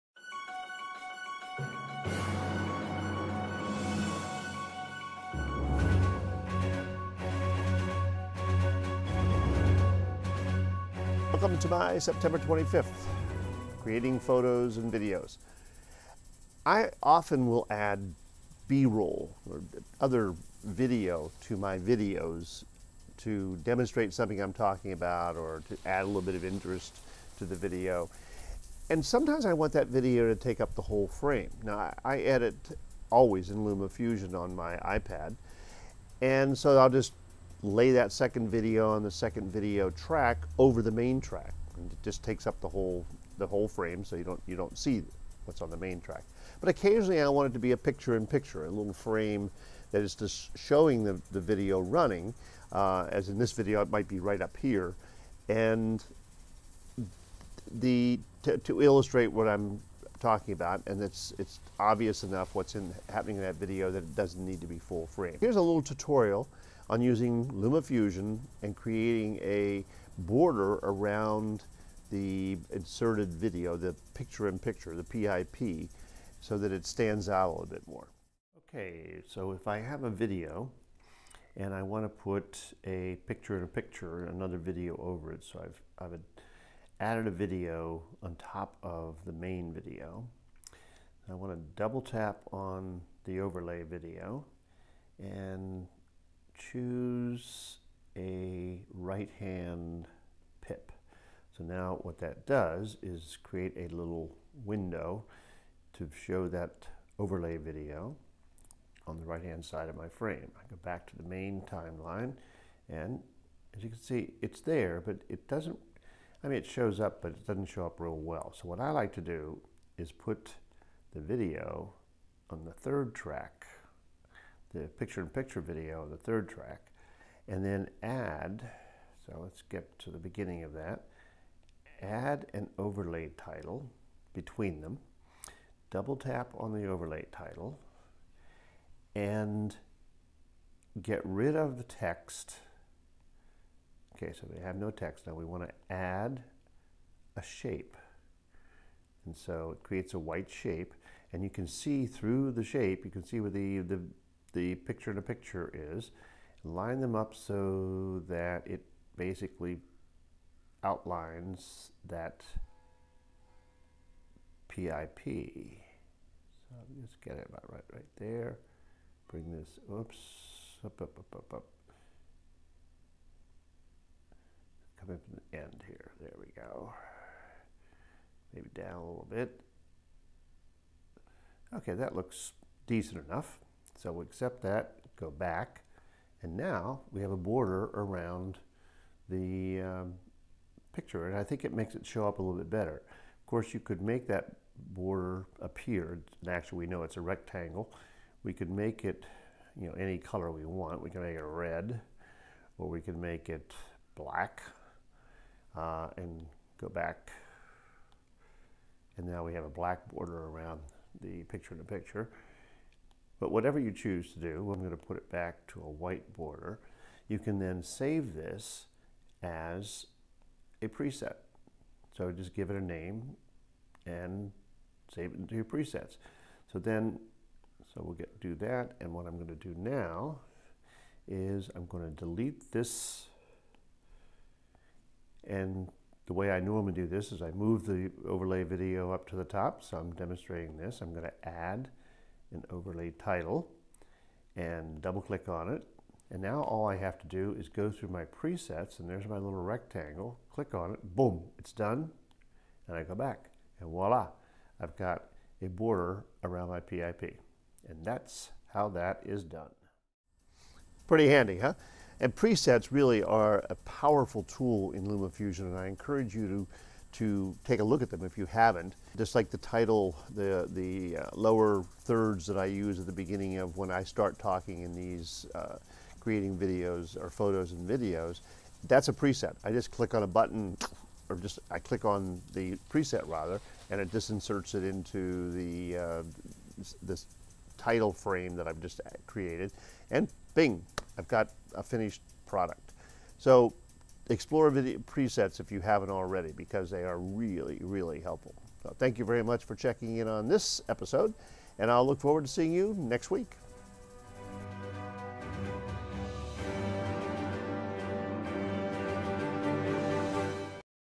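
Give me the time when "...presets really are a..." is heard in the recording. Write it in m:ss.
4:22.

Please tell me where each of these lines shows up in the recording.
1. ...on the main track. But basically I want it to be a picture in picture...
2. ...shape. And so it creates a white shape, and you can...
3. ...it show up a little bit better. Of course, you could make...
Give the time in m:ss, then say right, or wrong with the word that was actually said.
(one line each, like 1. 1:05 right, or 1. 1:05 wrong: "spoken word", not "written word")
1. 0:45 wrong: "occasionally", not "basically"
2. 2:27 right
3. 3:11 right.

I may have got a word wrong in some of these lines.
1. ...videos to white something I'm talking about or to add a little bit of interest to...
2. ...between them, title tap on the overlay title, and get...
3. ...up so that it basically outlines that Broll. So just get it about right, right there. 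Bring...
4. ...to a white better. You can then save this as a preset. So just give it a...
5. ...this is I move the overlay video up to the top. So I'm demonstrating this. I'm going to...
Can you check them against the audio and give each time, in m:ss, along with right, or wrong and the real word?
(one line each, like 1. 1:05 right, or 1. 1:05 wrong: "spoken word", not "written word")
1. 0:21 wrong: "demonstrate", not "white"
2. 2:14 wrong: "double", not "title"
3. 2:37 wrong: "PIP", not "Broll"
4. 3:35 wrong: "border", not "better"
5. 3:57 right.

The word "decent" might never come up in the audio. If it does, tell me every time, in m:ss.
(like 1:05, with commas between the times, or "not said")
3:02.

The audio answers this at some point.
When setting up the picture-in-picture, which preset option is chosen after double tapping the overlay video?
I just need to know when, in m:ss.
1:38.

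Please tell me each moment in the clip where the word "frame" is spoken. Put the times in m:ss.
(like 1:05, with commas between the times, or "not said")
0:31, 0:43, 0:48, 1:05, 1:50, 4:48.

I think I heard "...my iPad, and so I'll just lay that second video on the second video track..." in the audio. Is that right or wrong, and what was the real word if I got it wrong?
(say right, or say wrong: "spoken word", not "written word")
right.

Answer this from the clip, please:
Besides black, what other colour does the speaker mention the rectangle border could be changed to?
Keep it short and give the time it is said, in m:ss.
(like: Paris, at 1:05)
red, at 3:21.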